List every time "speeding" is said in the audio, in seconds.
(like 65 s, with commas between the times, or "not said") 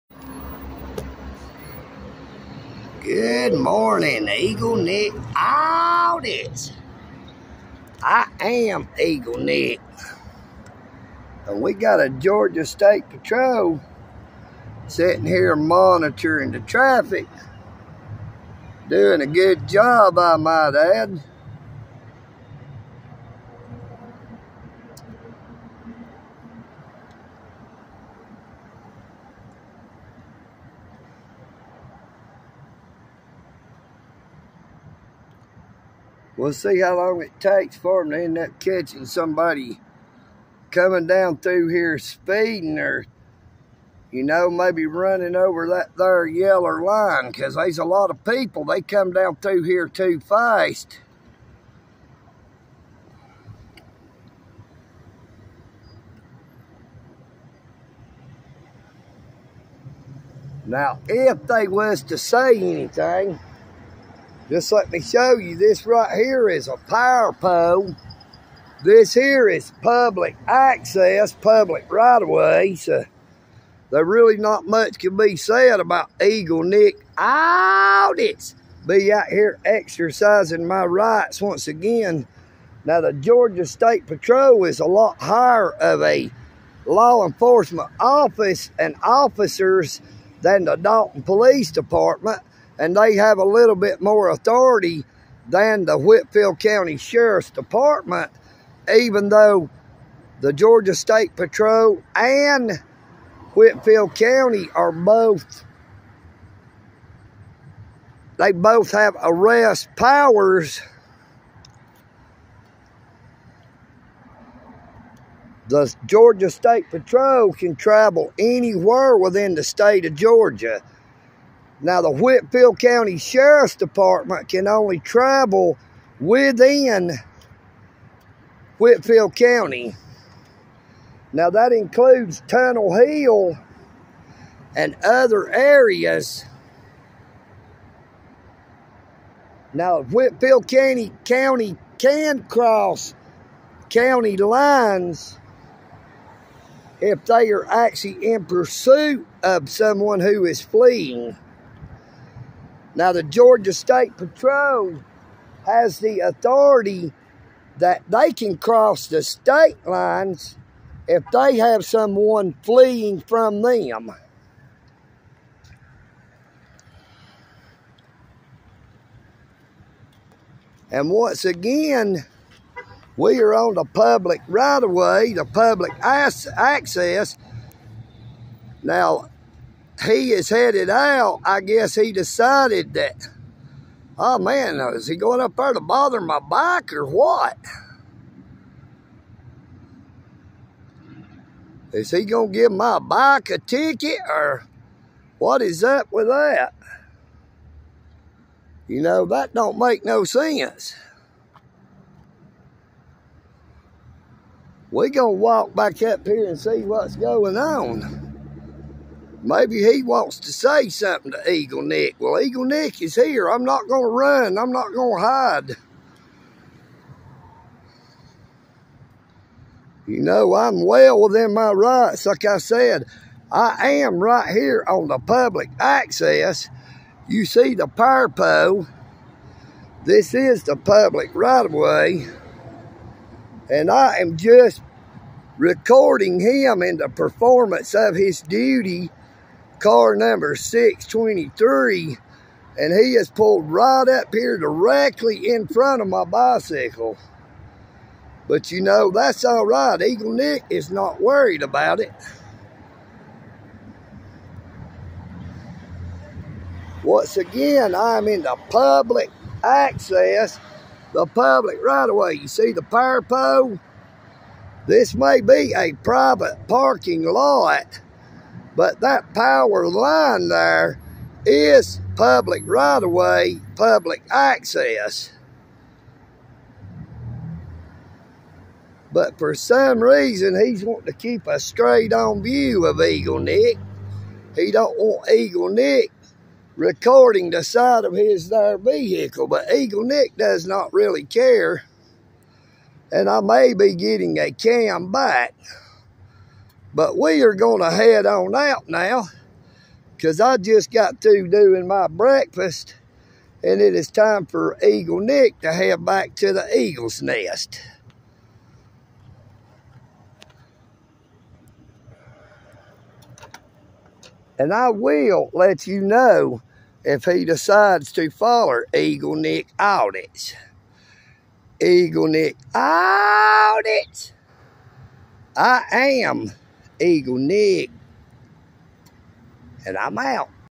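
41 s.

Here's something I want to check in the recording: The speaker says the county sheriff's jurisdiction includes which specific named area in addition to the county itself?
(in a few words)
Tunnel Hill.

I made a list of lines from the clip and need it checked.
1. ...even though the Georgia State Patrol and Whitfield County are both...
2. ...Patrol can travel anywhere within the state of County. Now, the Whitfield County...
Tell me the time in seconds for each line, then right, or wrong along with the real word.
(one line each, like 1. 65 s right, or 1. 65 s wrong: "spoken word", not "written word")
1. 98 s right
2. 116 s wrong: "Georgia", not "County".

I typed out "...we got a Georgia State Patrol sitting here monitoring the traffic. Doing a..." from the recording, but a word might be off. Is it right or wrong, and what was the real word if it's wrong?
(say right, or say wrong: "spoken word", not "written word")
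right.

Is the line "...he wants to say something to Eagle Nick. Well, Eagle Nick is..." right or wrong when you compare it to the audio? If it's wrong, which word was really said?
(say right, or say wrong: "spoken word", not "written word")
right.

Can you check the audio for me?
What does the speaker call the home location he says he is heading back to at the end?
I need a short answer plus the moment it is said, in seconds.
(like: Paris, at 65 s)
the eagle's nest, at 306 s.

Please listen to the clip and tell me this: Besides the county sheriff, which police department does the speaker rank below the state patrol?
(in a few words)
Dalton Police Department.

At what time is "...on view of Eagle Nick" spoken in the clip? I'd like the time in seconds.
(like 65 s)
282 s.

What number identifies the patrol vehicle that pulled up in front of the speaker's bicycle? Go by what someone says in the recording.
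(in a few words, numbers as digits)
623.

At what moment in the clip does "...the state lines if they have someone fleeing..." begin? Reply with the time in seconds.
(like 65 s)
159 s.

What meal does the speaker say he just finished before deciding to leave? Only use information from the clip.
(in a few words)
breakfast.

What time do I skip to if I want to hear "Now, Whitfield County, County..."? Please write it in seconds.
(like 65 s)
139 s.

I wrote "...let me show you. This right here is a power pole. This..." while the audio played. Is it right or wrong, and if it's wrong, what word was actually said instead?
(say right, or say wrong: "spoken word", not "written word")
right.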